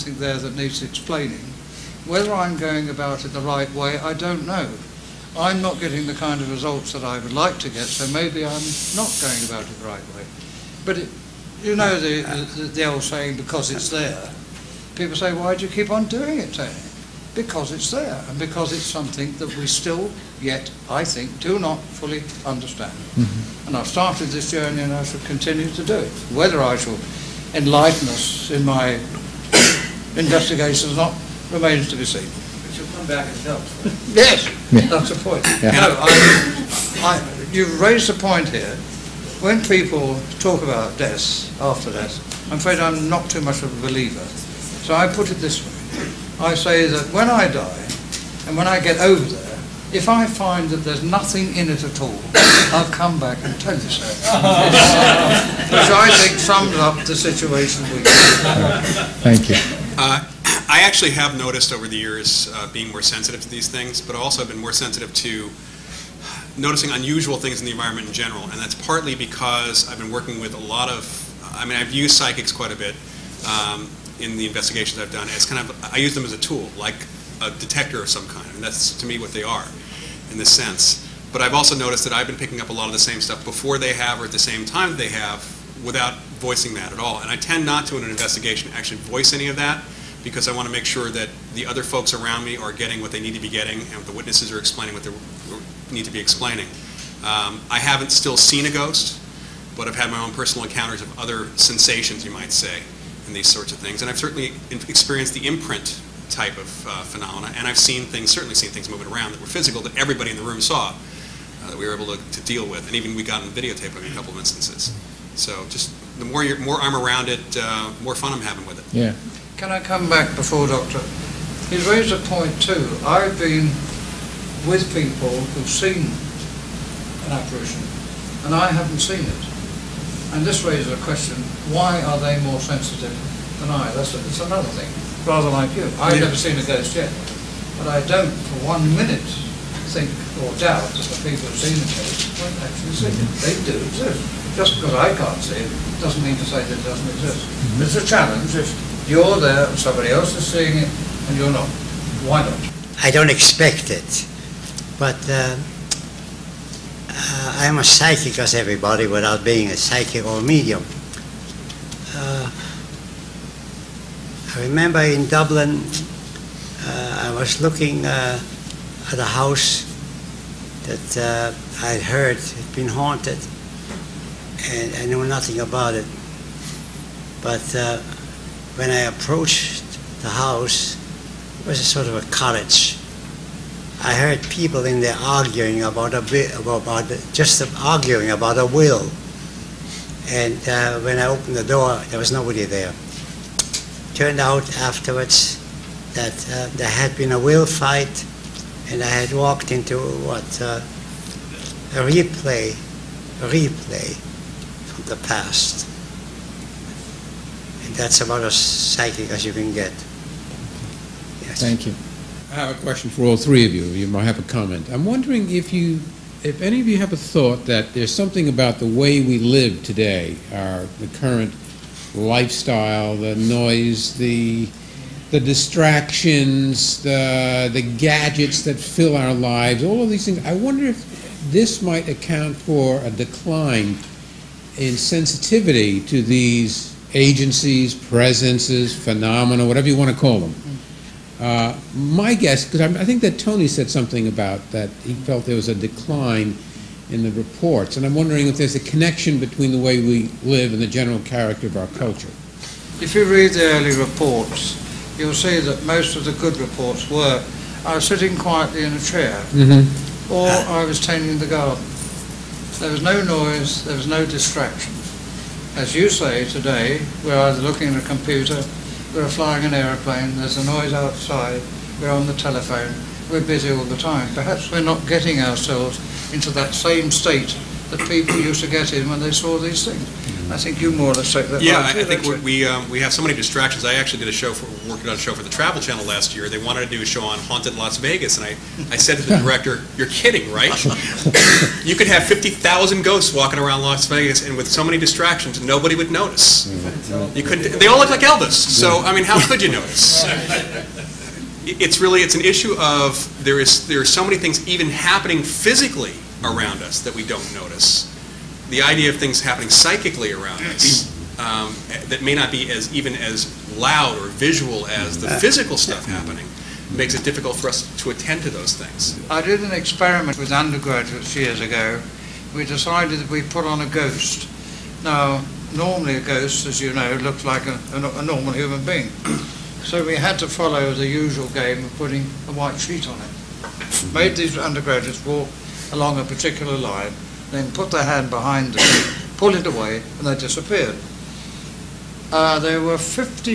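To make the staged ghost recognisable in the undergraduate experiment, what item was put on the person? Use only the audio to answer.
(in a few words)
A white sheet.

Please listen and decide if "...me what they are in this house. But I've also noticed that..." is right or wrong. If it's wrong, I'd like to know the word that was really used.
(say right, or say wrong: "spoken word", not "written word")
wrong: "sense", not "house".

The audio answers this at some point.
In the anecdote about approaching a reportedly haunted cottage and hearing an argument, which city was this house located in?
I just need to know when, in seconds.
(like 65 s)
165 s.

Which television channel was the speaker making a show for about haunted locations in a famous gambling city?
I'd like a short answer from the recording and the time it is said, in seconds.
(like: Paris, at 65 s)
Travel Channel, at 285 s.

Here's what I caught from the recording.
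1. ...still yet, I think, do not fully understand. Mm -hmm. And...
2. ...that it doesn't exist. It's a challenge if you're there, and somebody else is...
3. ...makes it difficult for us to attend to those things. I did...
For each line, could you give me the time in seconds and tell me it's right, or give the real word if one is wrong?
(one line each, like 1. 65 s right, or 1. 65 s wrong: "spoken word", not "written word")
1. 19 s right
2. 146 s right
3. 316 s right.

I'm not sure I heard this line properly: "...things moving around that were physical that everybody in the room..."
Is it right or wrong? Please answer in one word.
right.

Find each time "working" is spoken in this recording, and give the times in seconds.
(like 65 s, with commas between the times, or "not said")
70 s, 284 s.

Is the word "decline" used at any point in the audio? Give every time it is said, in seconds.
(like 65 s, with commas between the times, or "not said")
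233 s, 245 s.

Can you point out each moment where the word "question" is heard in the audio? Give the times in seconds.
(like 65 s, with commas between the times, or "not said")
131 s, 212 s.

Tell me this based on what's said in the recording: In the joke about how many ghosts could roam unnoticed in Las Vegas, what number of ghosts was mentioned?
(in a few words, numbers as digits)
50,000.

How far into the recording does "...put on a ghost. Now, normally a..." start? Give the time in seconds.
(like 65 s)
323 s.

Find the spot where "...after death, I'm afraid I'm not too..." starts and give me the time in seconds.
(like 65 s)
41 s.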